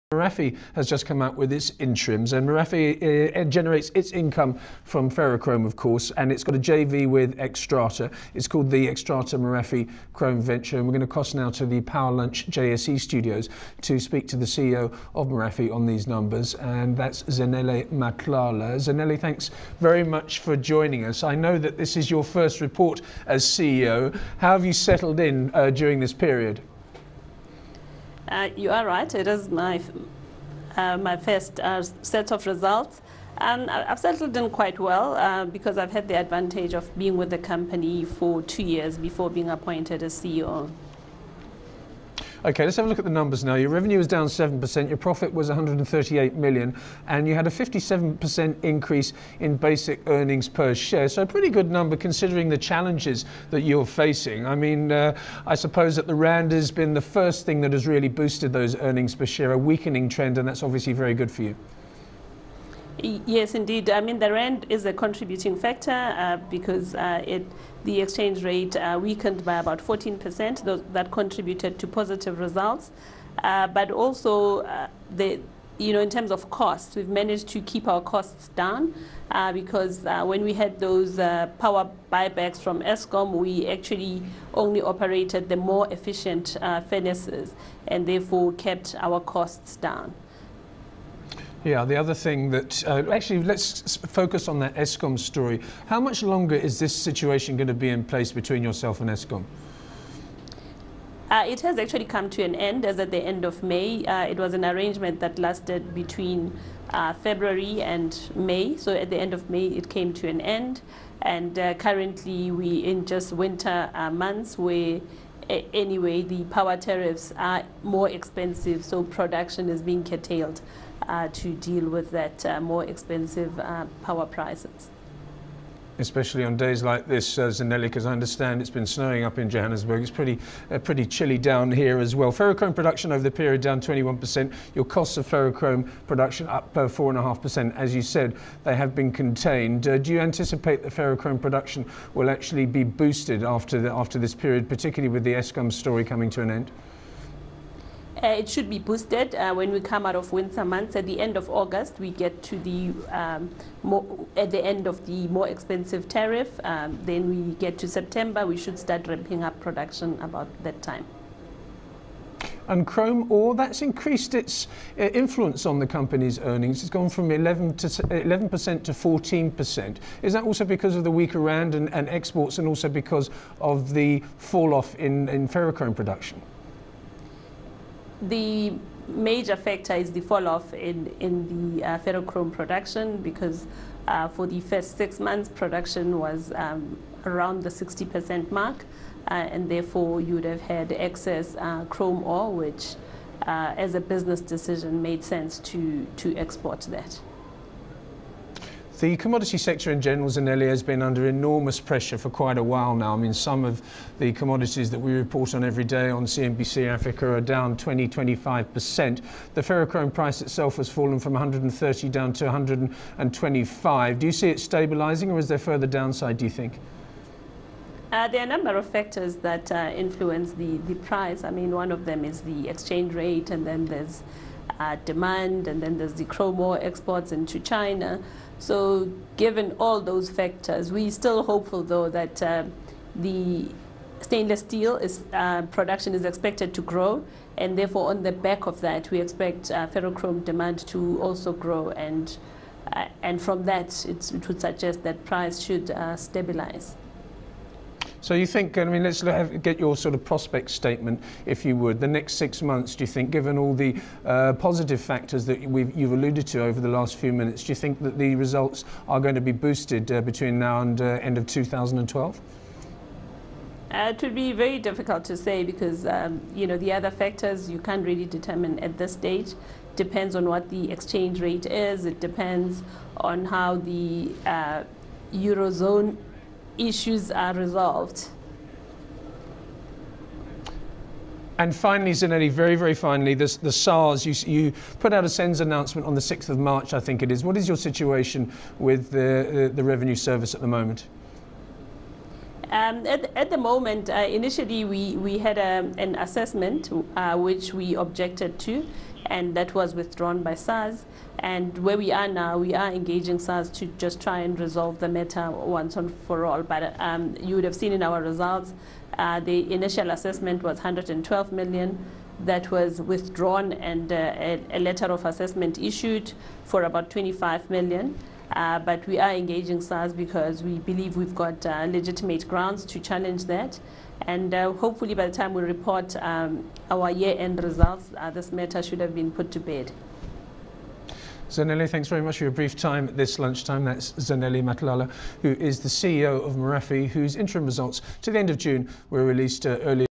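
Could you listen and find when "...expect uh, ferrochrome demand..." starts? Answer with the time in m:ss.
3:59.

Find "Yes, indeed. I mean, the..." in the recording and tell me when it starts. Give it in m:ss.
1:02.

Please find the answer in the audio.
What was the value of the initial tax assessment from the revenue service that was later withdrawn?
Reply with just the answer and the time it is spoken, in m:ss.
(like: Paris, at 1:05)
112 million, at 5:10.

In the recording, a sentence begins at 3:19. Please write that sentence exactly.
The commodity sector in general, Zanele, has been under enormous pressure for quite a while now.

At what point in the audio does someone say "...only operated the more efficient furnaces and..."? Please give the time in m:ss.
1:24.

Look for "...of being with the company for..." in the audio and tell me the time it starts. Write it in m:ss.
0:36.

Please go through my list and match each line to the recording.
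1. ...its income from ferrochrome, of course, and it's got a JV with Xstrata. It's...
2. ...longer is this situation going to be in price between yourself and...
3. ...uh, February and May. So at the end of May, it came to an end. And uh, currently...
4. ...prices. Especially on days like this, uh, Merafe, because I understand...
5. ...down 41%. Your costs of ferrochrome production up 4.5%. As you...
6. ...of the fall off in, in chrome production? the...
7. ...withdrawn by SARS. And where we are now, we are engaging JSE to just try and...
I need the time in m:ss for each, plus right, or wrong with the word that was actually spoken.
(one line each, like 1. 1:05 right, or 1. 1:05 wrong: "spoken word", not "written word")
1. 0:03 right
2. 1:36 wrong: "place", not "price"
3. 1:46 right
4. 2:04 wrong: "Zanele", not "Merafe"
5. 2:13 wrong: "21", not "41"
6. 2:53 wrong: "ferrochrome", not "chrome"
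7. 4:59 wrong: "SARS", not "JSE".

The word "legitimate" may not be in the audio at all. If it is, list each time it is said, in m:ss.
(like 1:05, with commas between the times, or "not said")
5:21.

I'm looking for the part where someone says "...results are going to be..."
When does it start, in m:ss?
4:18.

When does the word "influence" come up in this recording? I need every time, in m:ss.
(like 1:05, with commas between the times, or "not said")
2:45, 3:39.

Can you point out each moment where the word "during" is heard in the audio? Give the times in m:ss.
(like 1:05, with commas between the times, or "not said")
0:25.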